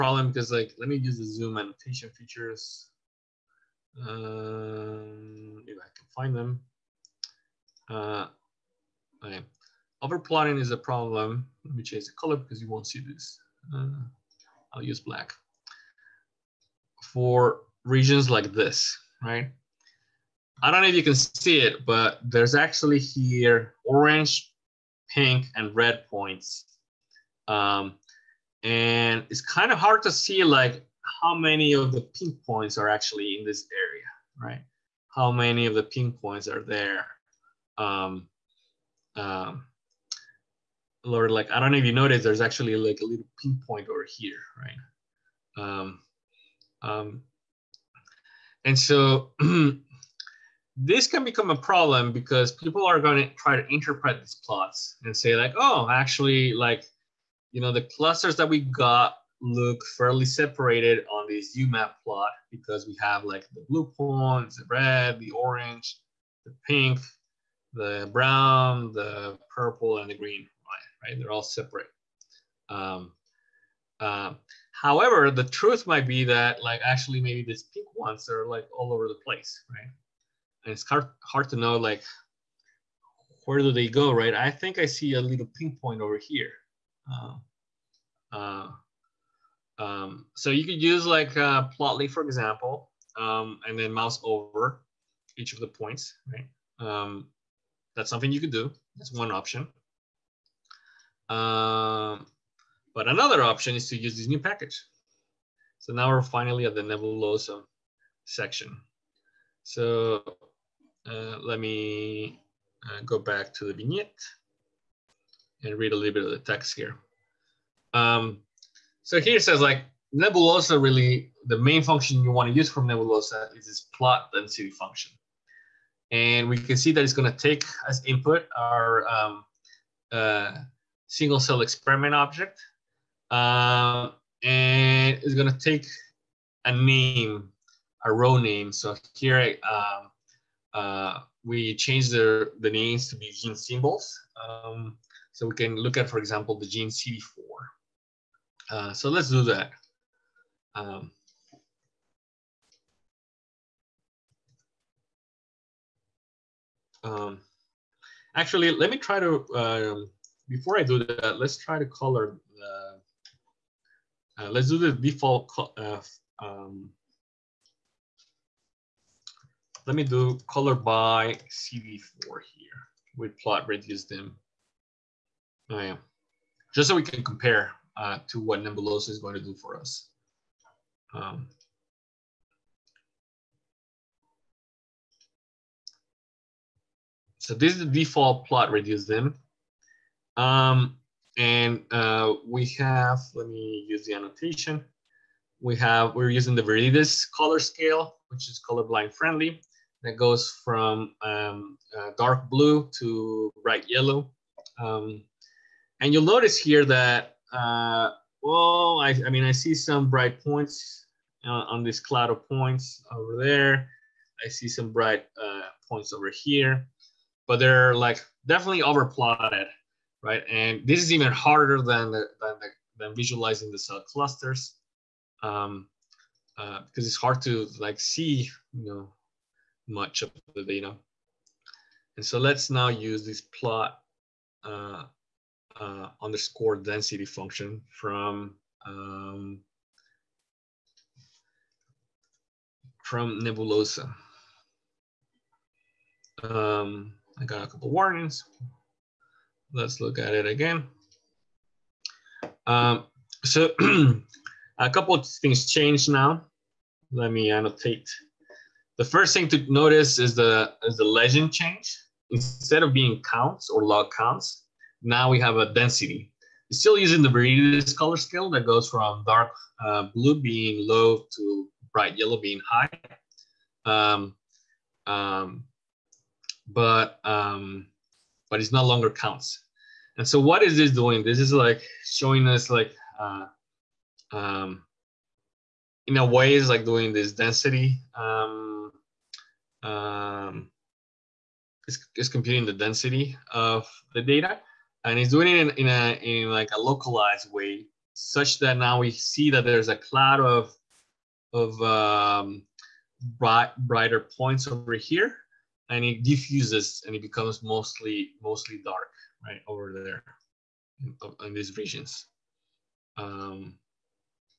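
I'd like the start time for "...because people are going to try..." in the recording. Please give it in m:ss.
0:52.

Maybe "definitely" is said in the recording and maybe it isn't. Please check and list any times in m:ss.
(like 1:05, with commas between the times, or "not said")
3:38.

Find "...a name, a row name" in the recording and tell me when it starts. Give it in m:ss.
2:16.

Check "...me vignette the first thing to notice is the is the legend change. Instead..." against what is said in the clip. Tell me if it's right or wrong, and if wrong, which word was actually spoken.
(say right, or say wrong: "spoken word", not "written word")
wrong: "annotate", not "vignette".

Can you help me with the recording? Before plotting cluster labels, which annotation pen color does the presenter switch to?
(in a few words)
Black.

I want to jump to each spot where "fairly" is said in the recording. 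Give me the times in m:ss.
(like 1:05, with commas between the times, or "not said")
0:59.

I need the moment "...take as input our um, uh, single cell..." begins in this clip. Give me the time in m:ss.
2:07.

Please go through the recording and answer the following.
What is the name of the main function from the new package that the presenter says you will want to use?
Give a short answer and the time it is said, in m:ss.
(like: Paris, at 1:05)
plot density, at 2:03.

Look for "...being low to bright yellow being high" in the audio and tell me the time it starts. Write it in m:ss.
4:30.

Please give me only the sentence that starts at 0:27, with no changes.
Um, and it's kind of hard to see like how many of the pink points are actually in this area, right?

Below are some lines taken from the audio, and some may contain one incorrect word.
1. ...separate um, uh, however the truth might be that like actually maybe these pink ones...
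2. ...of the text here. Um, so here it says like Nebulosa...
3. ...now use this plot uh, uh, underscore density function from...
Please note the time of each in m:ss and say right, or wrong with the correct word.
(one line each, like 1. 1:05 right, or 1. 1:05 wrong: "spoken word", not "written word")
1. 1:11 right
2. 1:56 right
3. 3:52 right.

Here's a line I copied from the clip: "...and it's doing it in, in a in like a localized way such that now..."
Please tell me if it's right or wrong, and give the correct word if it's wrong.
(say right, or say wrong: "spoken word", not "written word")
right.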